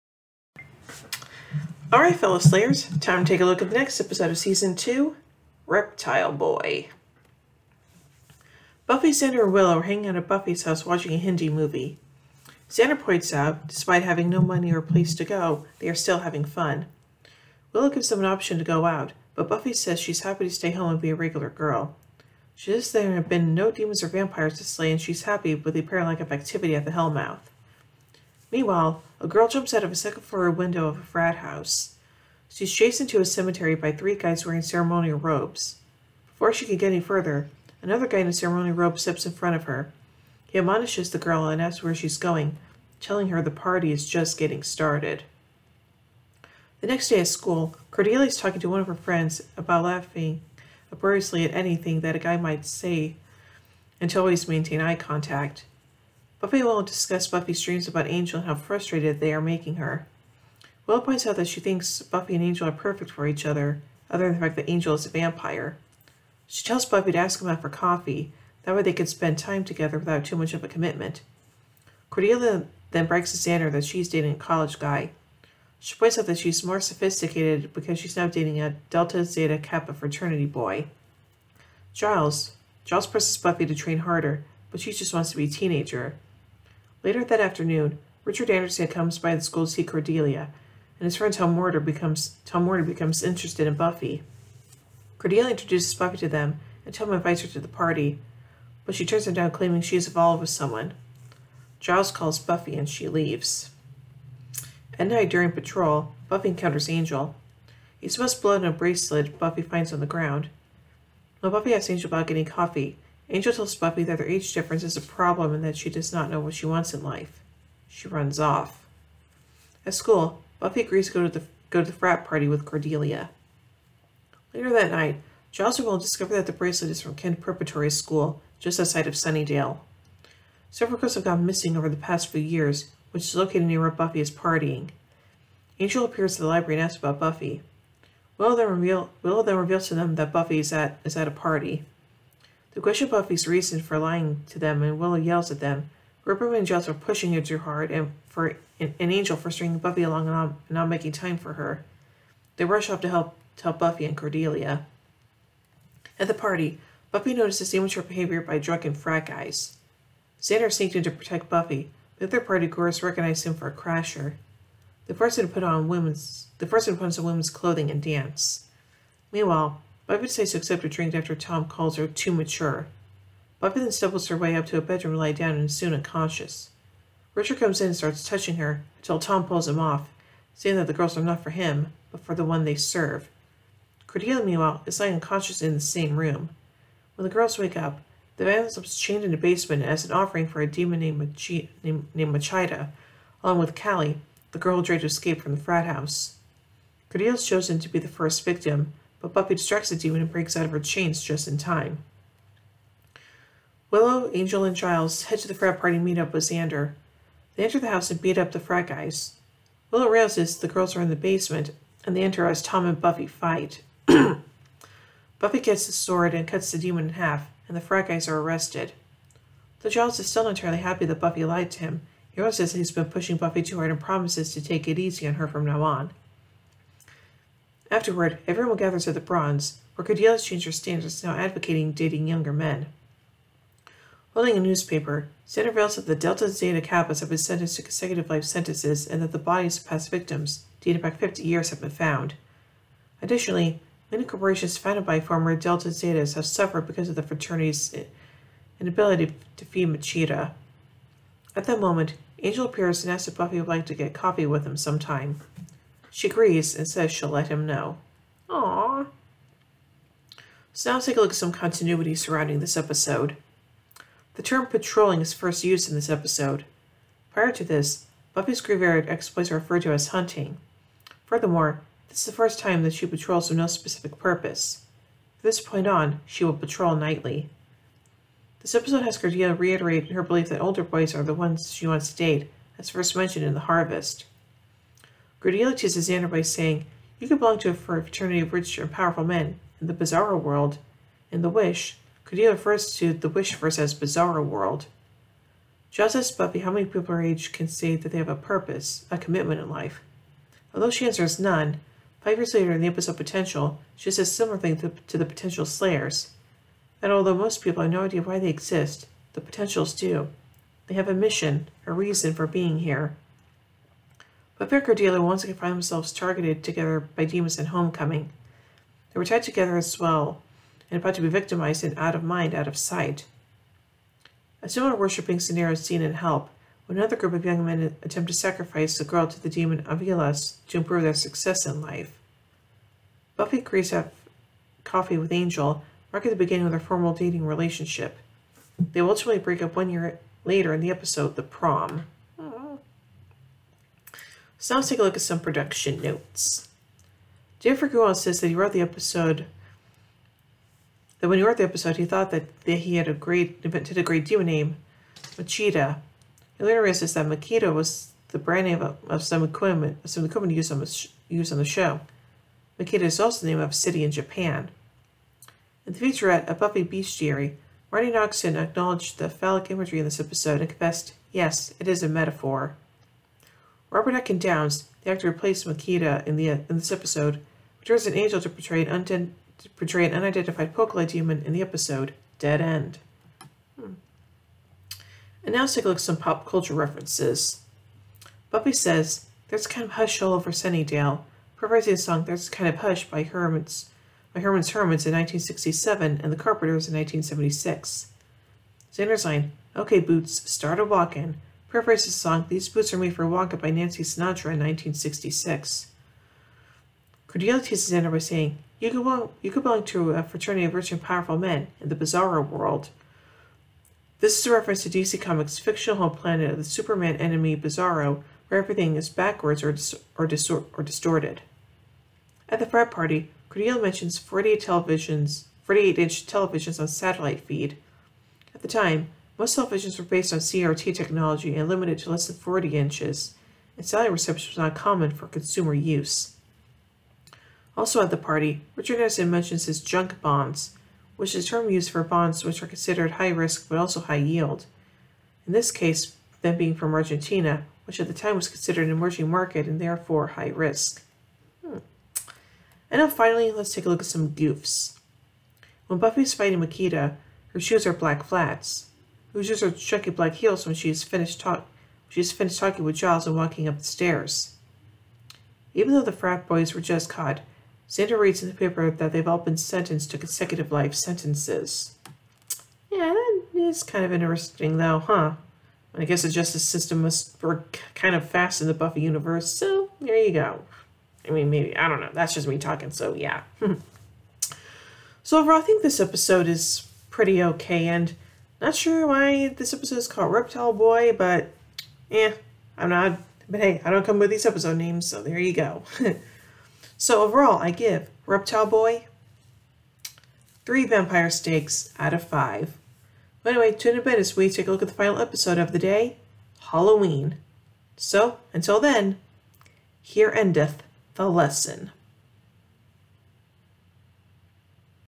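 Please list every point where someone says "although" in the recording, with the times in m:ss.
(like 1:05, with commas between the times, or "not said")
5:00, 5:07.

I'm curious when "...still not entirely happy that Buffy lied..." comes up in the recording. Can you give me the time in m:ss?
3:40.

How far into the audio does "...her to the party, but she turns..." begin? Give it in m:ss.
1:37.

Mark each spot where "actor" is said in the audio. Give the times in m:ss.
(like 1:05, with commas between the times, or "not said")
6:15.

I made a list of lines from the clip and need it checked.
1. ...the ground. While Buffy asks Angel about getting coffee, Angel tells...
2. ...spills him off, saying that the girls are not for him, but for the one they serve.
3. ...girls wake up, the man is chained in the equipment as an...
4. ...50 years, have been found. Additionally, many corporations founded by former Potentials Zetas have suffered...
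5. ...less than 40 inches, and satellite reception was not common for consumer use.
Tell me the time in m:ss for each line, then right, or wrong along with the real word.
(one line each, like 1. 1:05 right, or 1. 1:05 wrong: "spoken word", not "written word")
1. 1:49 right
2. 2:59 wrong: "pulls", not "spills"
3. 3:07 wrong: "basement", not "equipment"
4. 4:01 wrong: "Delta", not "Potentials"
5. 7:12 right.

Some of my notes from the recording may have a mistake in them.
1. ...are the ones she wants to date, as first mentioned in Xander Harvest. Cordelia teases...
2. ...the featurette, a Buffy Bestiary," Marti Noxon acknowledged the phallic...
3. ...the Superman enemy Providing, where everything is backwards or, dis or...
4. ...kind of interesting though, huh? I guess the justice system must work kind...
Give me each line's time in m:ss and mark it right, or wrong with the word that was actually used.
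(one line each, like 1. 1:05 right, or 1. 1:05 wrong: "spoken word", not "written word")
1. 4:41 wrong: "The", not "Xander"
2. 6:05 right
3. 6:56 wrong: "Bizarro", not "Providing"
4. 7:53 right.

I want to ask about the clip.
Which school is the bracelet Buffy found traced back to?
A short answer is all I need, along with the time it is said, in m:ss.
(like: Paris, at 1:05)
Kent Preparatory School, at 2:07.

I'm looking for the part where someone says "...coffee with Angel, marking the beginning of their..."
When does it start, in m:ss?
5:34.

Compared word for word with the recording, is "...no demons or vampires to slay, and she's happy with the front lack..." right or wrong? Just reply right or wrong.
wrong.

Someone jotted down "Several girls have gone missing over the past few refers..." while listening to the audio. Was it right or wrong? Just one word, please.
wrong.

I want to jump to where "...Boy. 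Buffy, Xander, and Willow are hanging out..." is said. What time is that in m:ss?
0:06.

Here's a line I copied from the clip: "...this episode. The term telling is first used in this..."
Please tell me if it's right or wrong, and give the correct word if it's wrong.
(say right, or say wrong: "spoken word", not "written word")
wrong: "patrolling", not "telling".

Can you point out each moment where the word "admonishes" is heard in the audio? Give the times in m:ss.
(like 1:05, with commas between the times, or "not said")
0:40.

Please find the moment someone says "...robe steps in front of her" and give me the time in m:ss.
0:38.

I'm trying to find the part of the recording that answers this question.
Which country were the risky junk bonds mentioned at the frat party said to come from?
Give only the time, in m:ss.
7:26.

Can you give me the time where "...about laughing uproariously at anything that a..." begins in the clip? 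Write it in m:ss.
0:49.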